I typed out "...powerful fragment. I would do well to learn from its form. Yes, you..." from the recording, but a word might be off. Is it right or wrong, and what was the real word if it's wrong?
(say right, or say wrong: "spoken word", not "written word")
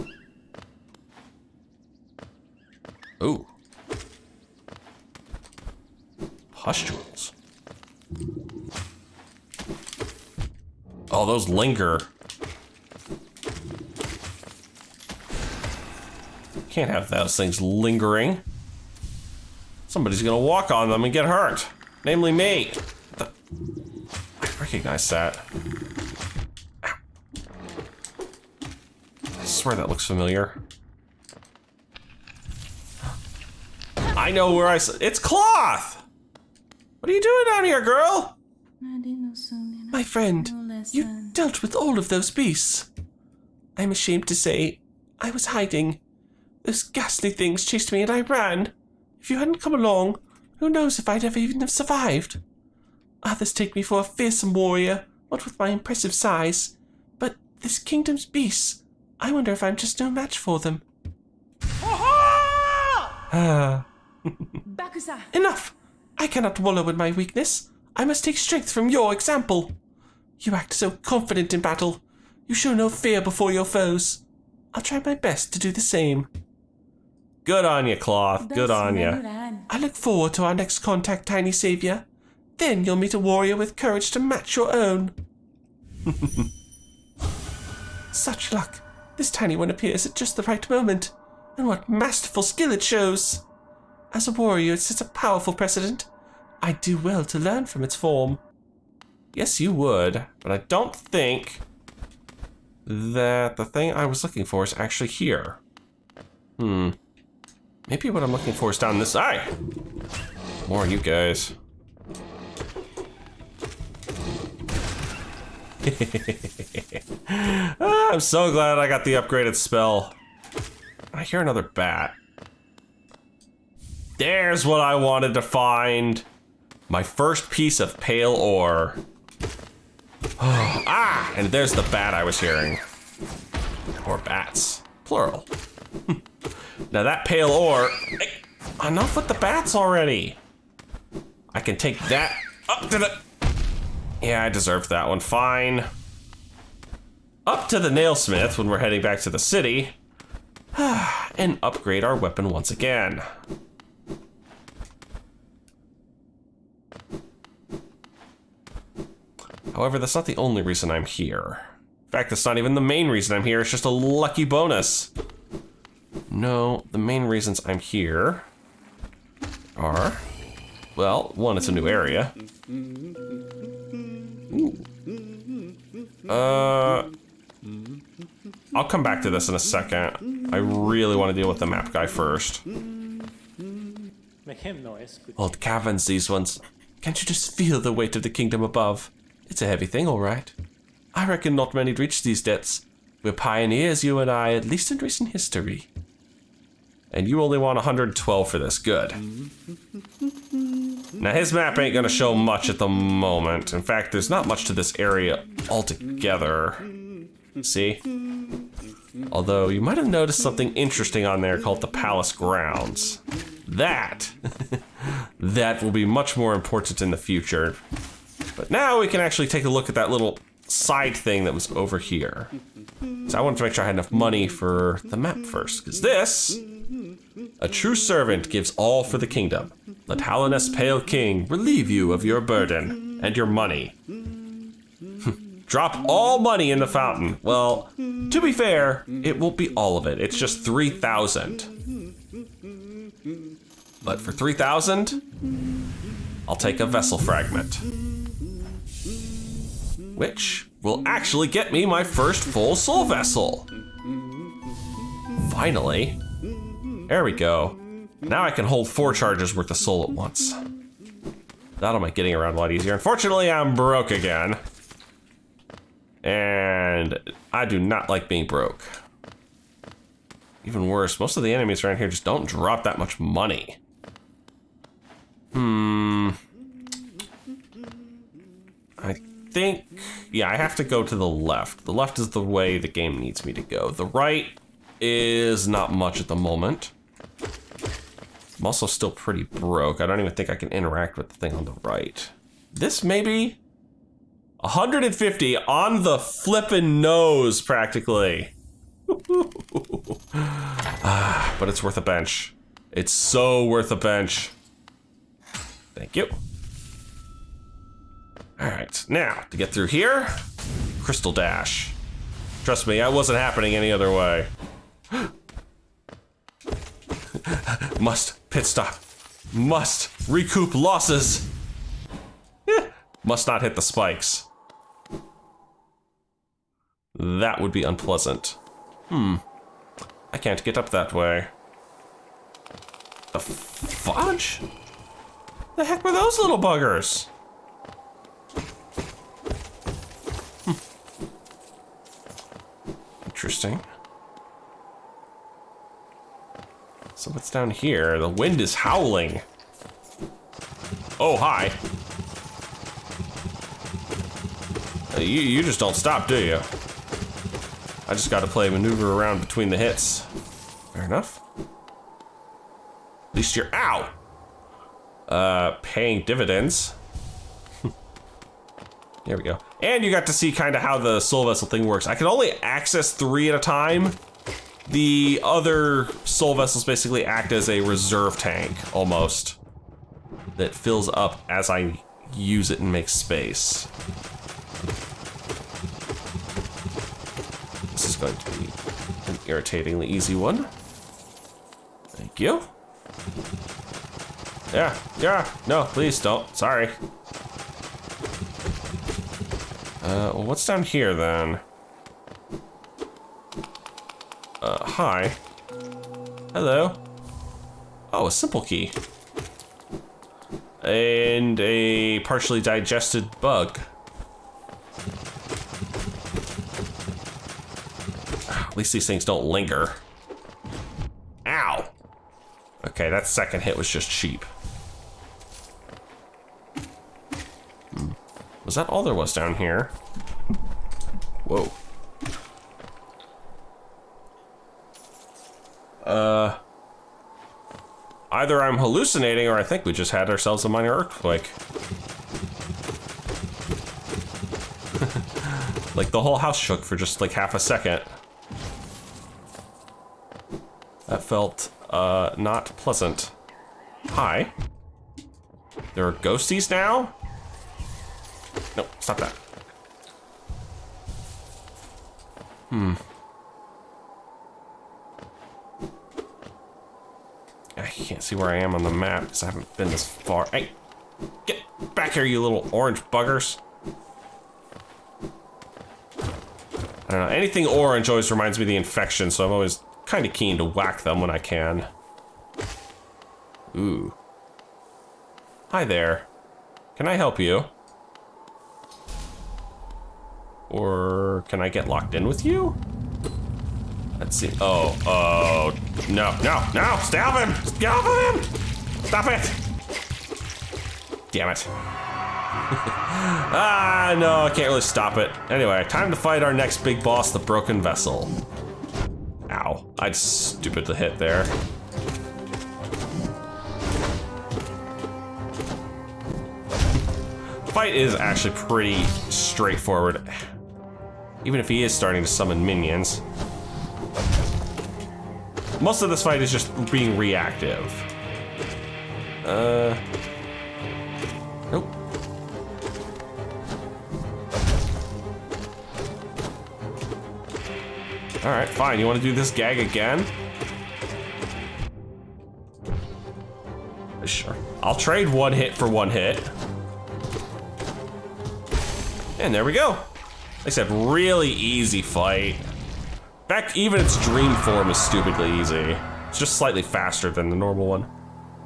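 wrong: "precedent", not "fragment".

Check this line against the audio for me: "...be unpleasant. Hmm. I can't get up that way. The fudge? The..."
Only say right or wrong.
right.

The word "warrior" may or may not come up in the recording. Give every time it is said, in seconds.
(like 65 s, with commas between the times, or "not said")
54 s, 83 s, 94 s.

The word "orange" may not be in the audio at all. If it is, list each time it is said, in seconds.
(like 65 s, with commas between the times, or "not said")
472 s, 477 s.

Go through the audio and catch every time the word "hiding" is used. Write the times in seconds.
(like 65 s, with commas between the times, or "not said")
45 s.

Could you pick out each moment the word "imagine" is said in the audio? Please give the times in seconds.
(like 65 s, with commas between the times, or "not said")
not said.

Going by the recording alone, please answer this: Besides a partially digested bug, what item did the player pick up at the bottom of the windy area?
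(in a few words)
Simple key.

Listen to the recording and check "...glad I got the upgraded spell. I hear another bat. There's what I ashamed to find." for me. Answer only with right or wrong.
wrong.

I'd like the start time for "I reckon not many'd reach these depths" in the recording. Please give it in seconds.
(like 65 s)
191 s.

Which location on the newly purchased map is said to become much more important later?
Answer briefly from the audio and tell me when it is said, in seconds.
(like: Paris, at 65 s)
Palace Grounds, at 211 s.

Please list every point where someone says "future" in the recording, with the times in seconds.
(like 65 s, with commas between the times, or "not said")
217 s.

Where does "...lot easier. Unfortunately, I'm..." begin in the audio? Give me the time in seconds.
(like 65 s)
262 s.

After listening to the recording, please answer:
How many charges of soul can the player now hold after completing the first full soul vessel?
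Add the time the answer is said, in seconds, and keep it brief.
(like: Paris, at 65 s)
4, at 258 s.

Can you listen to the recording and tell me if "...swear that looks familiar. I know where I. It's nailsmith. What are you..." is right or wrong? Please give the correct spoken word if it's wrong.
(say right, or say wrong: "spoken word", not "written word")
wrong: "cloth", not "nailsmith".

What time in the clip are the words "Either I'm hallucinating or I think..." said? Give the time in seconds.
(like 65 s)
438 s.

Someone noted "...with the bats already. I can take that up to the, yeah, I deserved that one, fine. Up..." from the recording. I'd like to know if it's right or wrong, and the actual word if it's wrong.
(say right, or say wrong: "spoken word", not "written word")
right.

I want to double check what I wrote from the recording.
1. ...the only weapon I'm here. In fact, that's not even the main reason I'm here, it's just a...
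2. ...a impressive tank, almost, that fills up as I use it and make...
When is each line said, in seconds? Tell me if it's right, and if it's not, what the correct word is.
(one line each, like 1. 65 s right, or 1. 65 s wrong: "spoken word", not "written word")
1. 160 s wrong: "reason", not "weapon"
2. 377 s wrong: "reserve", not "impressive".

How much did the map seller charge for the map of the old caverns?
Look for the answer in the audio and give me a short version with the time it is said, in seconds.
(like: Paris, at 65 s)
112, at 197 s.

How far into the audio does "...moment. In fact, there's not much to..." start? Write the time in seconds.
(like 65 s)
202 s.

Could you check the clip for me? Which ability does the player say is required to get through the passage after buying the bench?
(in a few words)
Crystal dash.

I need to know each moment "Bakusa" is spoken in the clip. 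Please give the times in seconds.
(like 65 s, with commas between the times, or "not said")
64 s.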